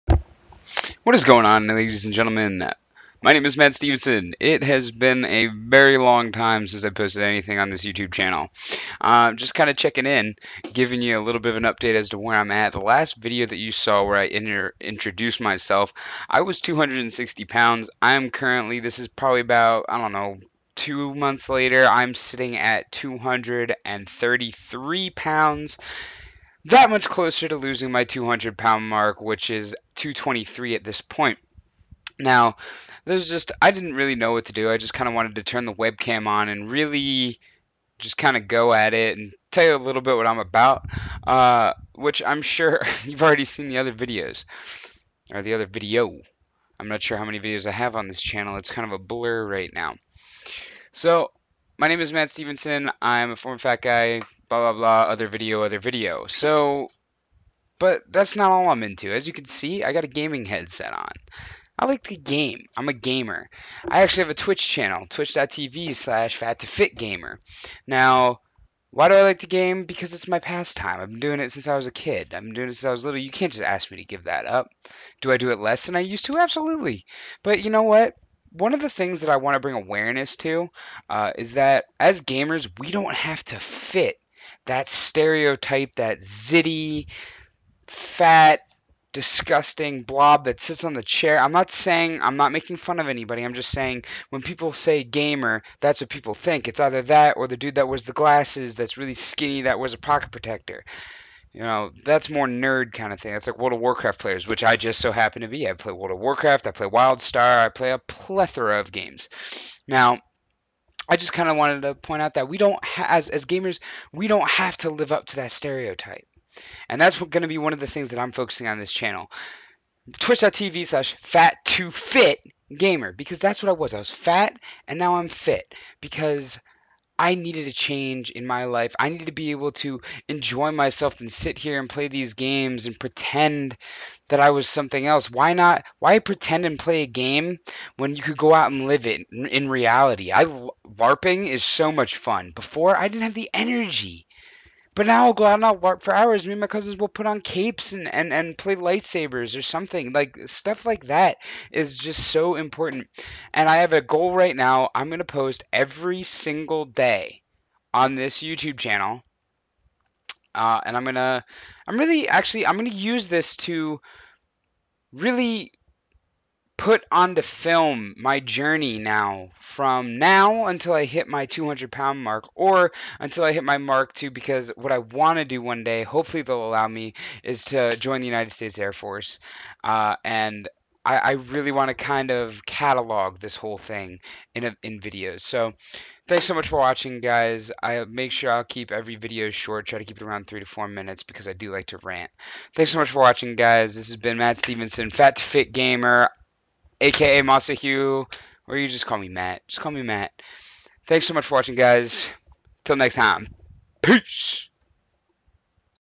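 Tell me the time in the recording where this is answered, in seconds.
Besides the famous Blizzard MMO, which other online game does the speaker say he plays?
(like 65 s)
106 s.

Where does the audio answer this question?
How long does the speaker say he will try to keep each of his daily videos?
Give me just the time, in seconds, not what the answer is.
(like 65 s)
190 s.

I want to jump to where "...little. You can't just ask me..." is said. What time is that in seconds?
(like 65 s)
73 s.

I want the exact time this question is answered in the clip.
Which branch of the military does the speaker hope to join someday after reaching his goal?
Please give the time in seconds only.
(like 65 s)
178 s.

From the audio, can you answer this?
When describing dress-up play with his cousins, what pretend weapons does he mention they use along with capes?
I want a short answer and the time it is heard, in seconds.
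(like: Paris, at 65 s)
lightsabers, at 148 s.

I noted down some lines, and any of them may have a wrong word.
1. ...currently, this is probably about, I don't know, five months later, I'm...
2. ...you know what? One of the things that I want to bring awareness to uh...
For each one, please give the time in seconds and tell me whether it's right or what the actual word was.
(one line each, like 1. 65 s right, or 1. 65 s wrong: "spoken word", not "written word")
1. 18 s wrong: "two", not "five"
2. 77 s right.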